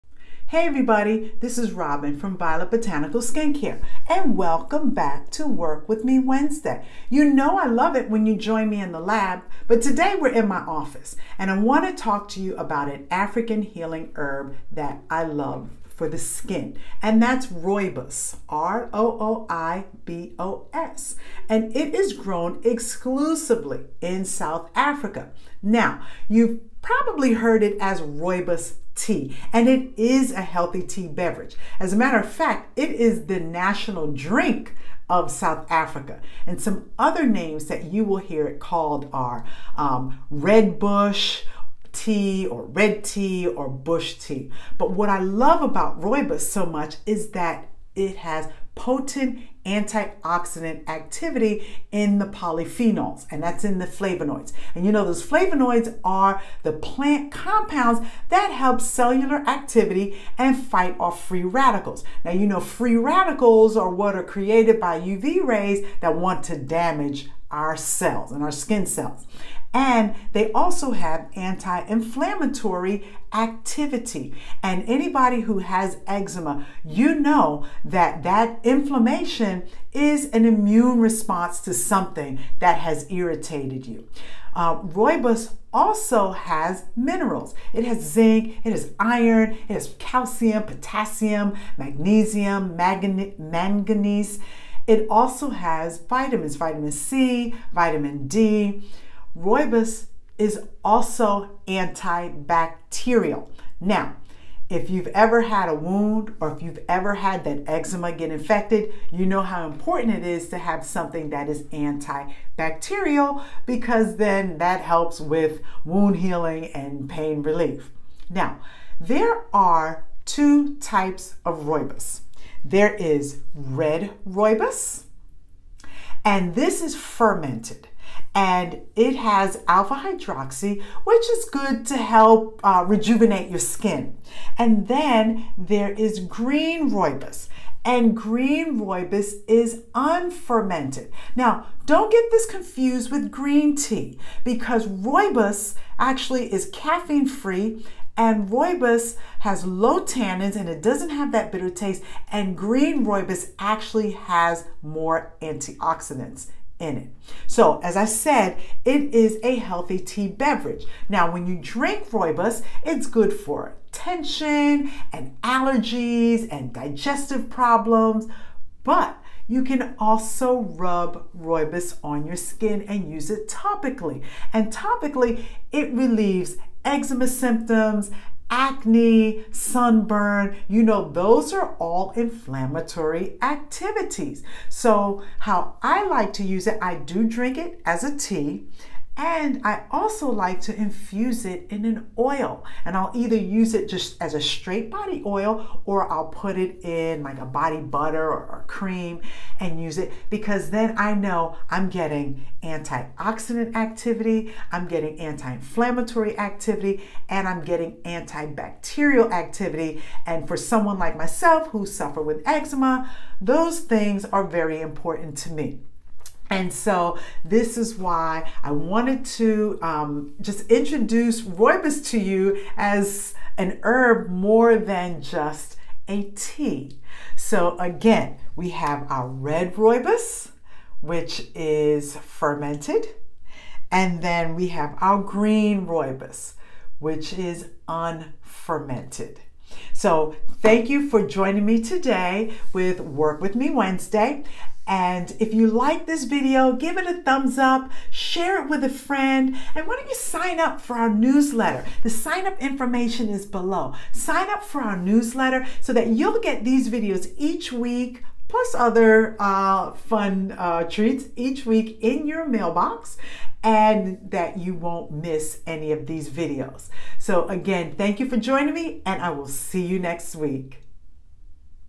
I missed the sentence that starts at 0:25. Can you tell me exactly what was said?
Now, you've probably heard it as rooibos tea, and it is a healthy tea beverage.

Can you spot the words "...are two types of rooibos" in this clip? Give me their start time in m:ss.
1:59.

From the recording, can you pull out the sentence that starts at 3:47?
So, again, we have our red rooibos, which is fermented, and then we have our green rooibos, which is unfermented.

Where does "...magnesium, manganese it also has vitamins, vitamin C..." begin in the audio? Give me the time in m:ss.
1:31.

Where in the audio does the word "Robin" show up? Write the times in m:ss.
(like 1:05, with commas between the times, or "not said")
0:01.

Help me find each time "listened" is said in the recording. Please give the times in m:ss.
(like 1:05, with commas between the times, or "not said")
not said.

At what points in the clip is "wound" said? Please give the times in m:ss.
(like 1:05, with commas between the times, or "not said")
1:45, 1:55.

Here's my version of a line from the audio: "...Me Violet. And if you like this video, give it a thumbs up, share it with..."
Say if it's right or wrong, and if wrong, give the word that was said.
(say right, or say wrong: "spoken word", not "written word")
wrong: "Wednesday", not "Violet".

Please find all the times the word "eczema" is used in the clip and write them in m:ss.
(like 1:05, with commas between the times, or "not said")
1:16, 1:47, 2:56, 3:32.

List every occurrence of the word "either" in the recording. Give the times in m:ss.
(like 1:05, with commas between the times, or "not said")
3:13.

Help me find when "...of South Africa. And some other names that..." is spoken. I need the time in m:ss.
0:35.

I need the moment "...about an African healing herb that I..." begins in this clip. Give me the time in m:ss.
0:12.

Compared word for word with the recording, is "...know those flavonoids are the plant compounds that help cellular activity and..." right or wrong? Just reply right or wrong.
right.